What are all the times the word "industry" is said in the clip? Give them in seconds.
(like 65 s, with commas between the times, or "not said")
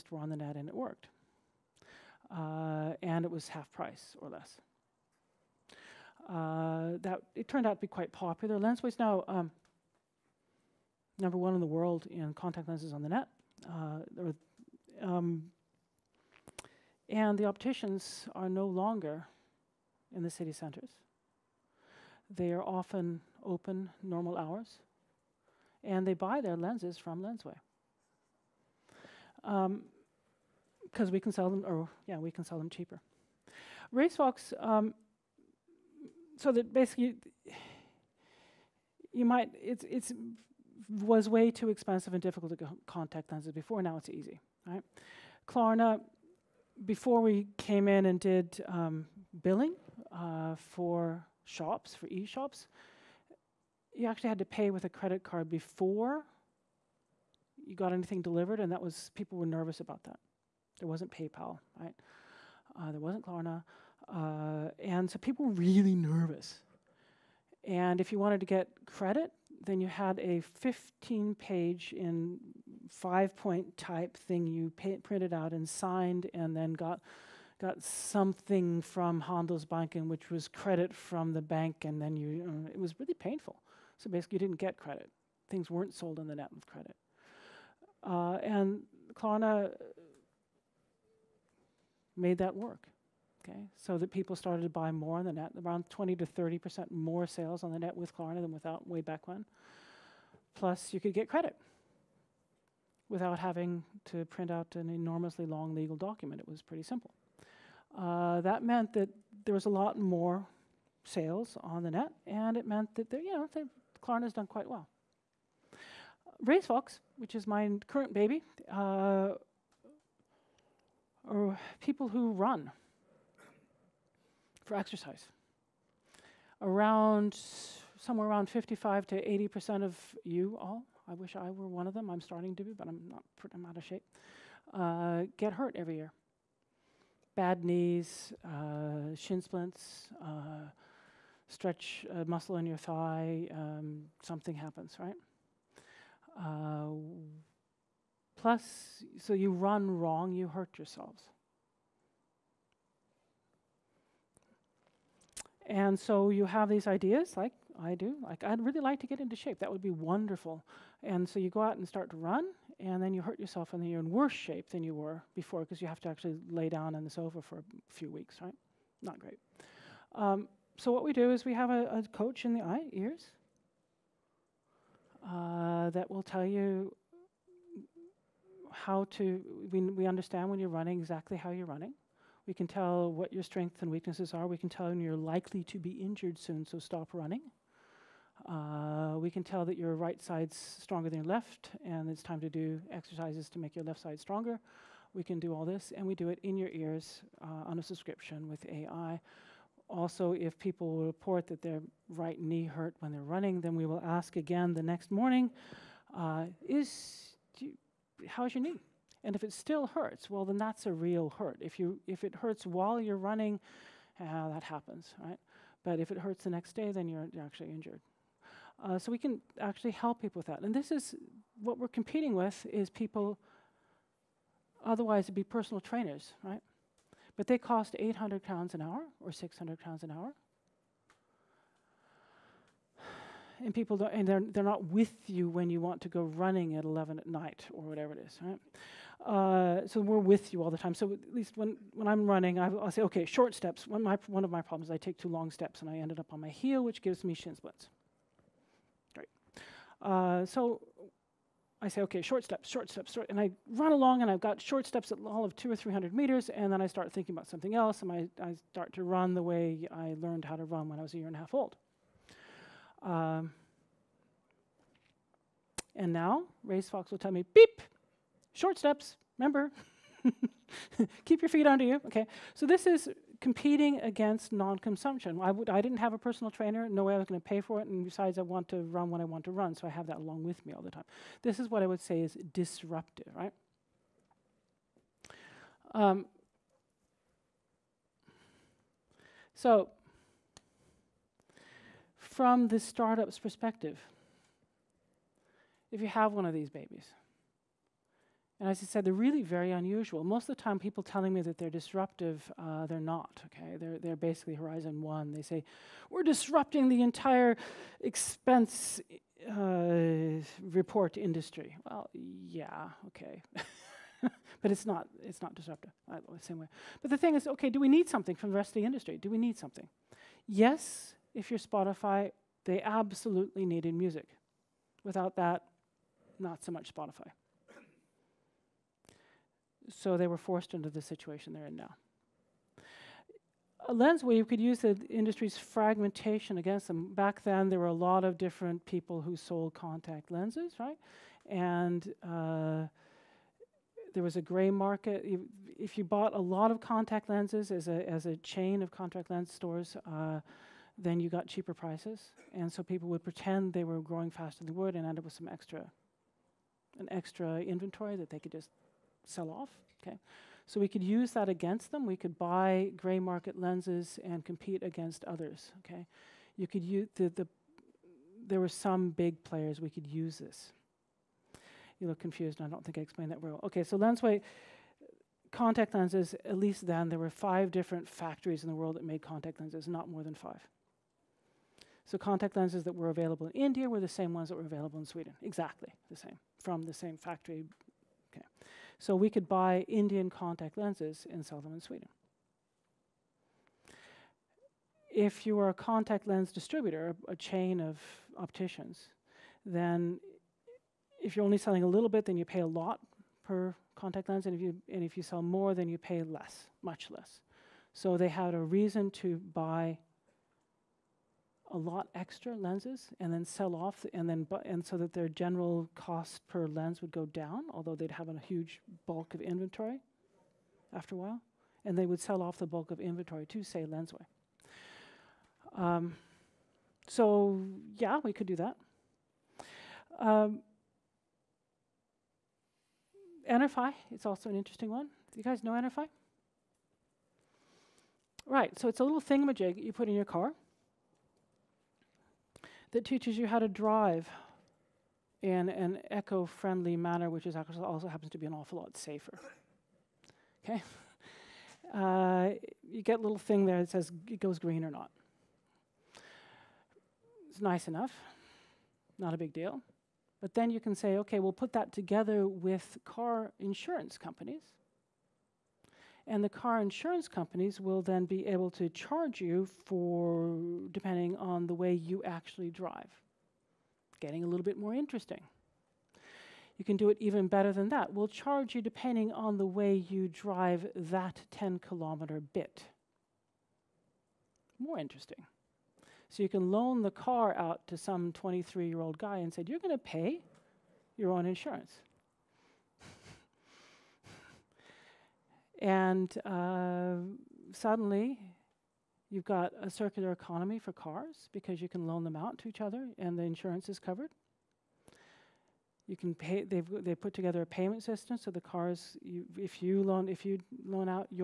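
311 s, 318 s, 335 s.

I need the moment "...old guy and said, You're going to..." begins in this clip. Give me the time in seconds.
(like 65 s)
488 s.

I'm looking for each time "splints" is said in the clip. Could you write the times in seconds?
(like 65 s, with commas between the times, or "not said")
139 s, 247 s.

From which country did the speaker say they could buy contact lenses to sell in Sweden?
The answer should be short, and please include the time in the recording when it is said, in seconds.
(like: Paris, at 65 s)
India, at 389 s.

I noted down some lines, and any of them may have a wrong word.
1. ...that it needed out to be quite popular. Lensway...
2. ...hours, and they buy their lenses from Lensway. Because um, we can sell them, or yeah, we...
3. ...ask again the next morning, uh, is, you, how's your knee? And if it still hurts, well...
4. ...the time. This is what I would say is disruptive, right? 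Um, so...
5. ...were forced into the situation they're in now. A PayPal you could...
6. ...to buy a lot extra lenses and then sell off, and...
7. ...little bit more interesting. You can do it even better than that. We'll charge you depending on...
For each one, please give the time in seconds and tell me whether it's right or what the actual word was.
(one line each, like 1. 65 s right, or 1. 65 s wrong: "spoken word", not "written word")
1. 7 s wrong: "turned", not "needed"
2. 24 s right
3. 204 s right
4. 280 s right
5. 330 s wrong: "Lensway", not "PayPal"
6. 409 s right
7. 474 s right.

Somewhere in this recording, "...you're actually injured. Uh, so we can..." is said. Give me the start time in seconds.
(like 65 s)
217 s.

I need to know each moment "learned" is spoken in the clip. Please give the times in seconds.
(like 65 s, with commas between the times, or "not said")
260 s.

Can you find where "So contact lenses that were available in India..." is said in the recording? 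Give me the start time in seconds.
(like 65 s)
382 s.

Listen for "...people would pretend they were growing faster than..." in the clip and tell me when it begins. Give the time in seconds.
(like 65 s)
352 s.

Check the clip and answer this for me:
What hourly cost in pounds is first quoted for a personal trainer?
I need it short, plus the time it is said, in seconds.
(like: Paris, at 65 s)
800 pounds, at 227 s.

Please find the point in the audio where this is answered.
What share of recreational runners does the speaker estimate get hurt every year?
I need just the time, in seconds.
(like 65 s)
128 s.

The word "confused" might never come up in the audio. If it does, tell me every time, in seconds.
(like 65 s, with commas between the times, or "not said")
372 s.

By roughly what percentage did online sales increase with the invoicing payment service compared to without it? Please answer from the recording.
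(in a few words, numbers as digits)
20 to 30%.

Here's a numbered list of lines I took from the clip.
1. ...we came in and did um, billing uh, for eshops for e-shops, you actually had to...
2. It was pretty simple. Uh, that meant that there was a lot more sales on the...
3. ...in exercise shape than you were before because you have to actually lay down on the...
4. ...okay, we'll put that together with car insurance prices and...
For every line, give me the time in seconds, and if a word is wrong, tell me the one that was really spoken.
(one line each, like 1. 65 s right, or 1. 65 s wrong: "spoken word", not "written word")
1. 47 s wrong: "shops", not "eshops"
2. 106 s right
3. 163 s wrong: "worse", not "exercise"
4. 461 s wrong: "companies", not "prices".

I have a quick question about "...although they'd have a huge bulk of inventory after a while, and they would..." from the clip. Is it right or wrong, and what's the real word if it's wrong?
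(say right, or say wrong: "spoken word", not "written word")
right.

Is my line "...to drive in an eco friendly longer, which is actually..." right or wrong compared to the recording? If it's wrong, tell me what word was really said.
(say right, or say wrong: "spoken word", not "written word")
wrong: "manner", not "longer".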